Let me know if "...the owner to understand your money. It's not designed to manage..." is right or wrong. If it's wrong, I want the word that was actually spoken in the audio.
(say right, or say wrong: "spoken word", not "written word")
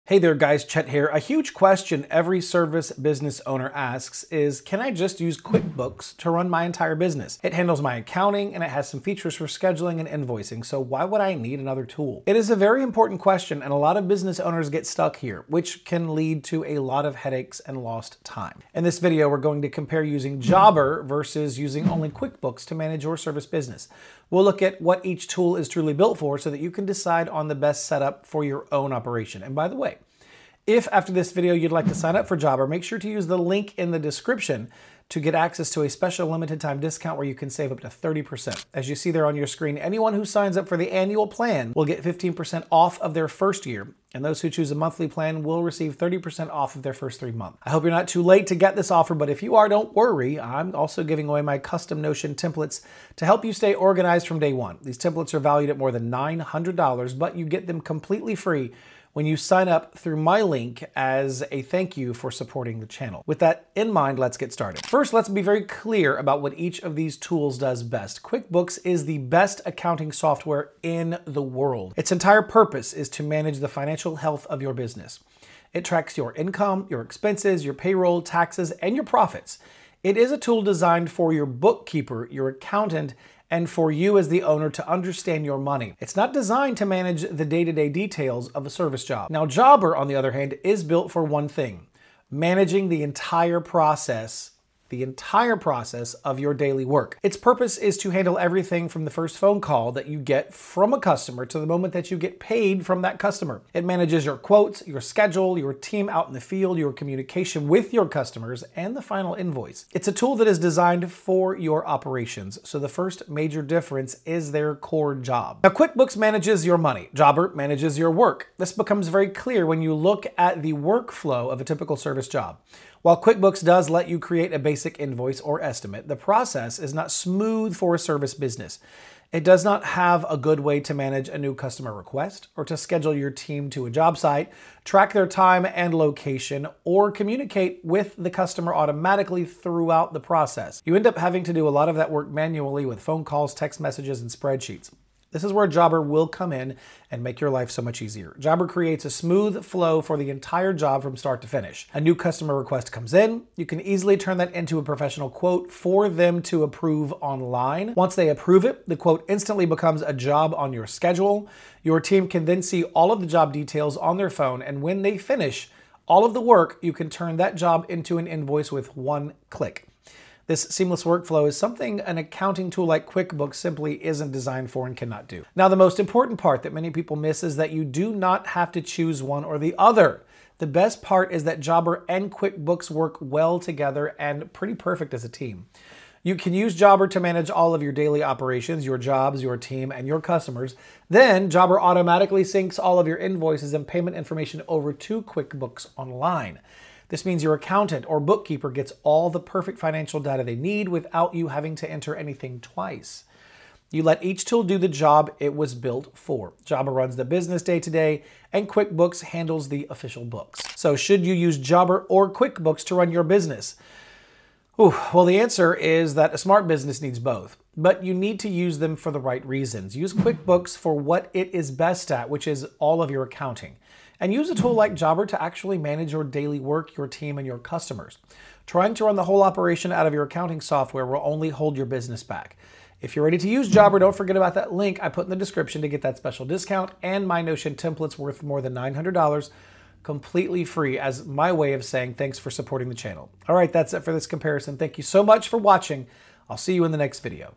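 right.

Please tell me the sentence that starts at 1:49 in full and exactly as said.
It's a tool that is designed for your operations, so the first major difference is their core job.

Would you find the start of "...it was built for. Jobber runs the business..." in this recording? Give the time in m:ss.
3:25.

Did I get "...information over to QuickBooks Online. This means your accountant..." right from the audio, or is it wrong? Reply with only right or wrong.
right.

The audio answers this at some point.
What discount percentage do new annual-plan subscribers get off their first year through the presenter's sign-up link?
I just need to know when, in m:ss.
0:42.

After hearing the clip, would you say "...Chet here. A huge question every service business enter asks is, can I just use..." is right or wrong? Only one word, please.
wrong.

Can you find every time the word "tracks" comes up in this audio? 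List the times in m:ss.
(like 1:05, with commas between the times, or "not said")
1:15, 2:14.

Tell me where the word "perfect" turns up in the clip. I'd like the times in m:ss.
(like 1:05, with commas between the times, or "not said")
3:04, 3:19.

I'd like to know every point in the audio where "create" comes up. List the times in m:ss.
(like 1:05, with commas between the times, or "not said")
2:04, 2:28.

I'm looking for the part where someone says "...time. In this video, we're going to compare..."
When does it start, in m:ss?
0:18.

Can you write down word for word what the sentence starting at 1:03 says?
With that in mind, let's get started.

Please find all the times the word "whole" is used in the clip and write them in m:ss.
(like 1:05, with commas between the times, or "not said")
3:49.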